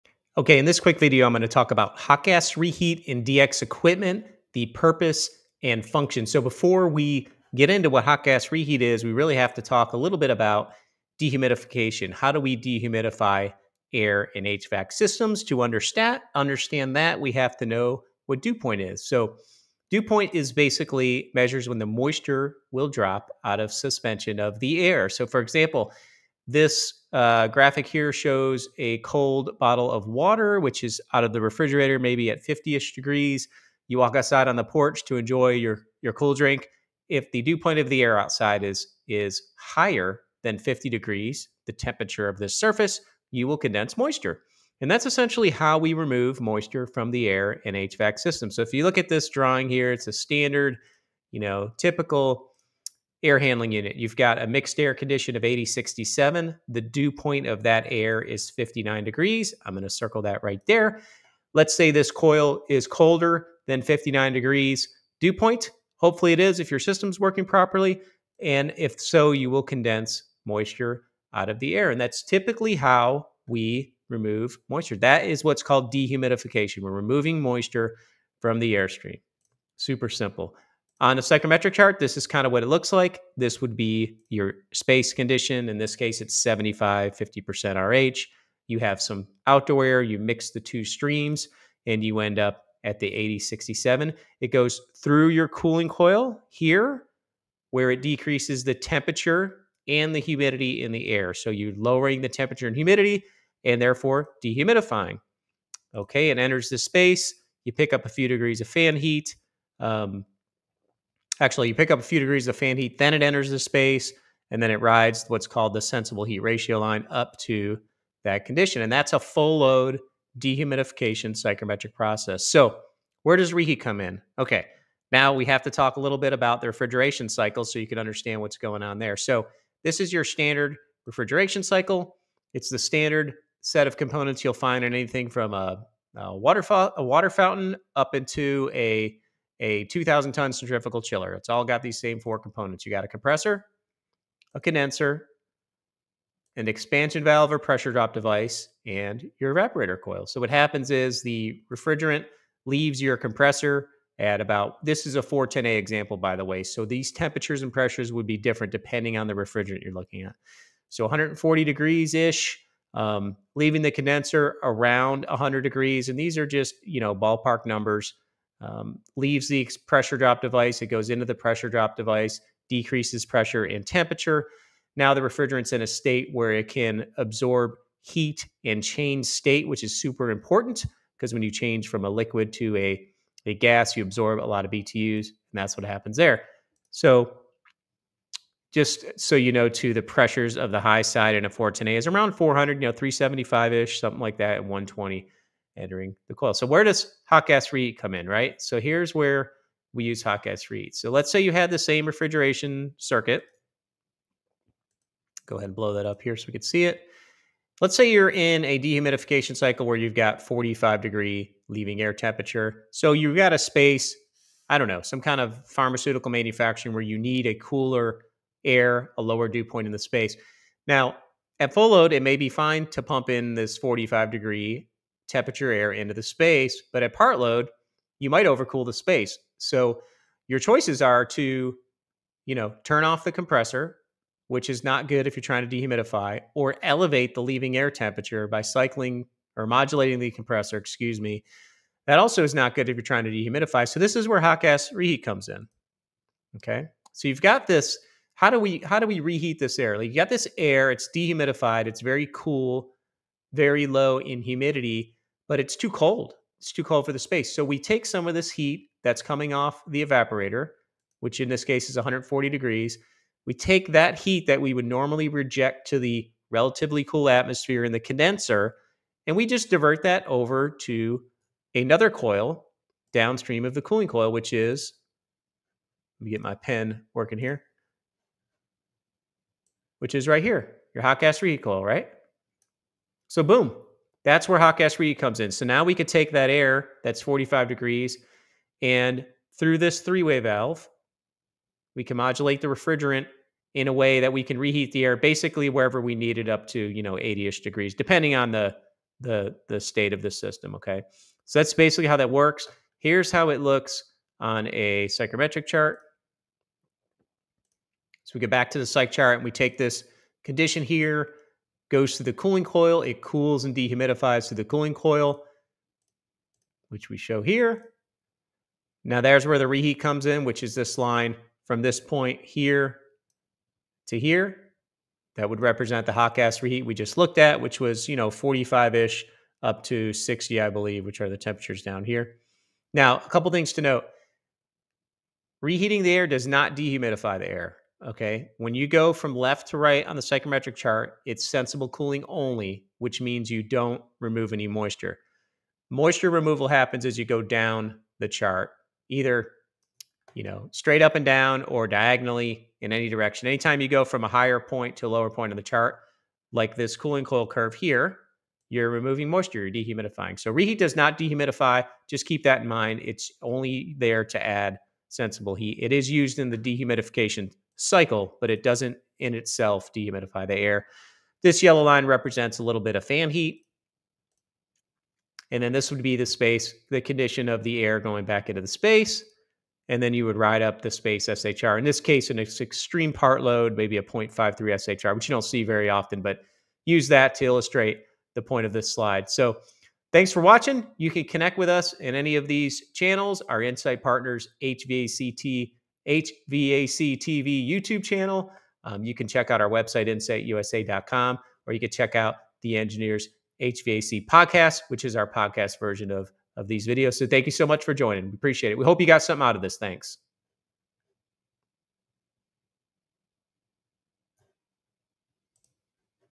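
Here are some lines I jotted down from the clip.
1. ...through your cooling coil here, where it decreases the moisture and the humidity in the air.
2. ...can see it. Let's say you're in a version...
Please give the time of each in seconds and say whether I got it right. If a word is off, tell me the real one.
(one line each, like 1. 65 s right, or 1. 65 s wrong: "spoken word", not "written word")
1. 94 s wrong: "temperature", not "moisture"
2. 206 s wrong: "dehumidification", not "version".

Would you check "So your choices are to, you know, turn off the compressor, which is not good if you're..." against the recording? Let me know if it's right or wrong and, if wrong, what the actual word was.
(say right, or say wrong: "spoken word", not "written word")
right.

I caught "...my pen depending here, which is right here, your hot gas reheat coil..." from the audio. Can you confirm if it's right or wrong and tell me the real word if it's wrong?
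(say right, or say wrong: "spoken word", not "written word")
wrong: "working", not "depending".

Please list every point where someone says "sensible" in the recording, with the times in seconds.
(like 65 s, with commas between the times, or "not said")
115 s, 341 s, 365 s.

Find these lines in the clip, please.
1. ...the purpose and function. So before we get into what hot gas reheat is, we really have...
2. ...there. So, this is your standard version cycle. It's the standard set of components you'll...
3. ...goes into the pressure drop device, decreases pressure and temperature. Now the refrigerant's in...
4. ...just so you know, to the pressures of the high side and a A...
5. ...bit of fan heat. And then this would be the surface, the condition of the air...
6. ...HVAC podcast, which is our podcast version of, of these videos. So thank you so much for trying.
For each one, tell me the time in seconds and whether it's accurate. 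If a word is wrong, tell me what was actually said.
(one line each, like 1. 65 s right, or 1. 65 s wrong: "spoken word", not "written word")
1. 4 s right
2. 128 s wrong: "refrigeration", not "version"
3. 170 s right
4. 188 s right
5. 372 s wrong: "space", not "surface"
6. 403 s wrong: "joining", not "trying".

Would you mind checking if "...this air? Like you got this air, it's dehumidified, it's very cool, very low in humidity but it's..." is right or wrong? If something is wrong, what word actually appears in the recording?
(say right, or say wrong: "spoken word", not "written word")
right.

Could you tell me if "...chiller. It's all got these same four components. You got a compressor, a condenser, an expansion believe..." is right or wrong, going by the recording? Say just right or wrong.
wrong.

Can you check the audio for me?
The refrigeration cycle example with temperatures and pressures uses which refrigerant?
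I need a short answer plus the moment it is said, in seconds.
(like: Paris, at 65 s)
410A, at 155 s.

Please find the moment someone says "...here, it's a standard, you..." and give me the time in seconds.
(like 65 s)
49 s.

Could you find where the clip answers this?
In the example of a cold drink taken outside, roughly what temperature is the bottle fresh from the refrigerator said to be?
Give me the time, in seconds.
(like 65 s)
32 s.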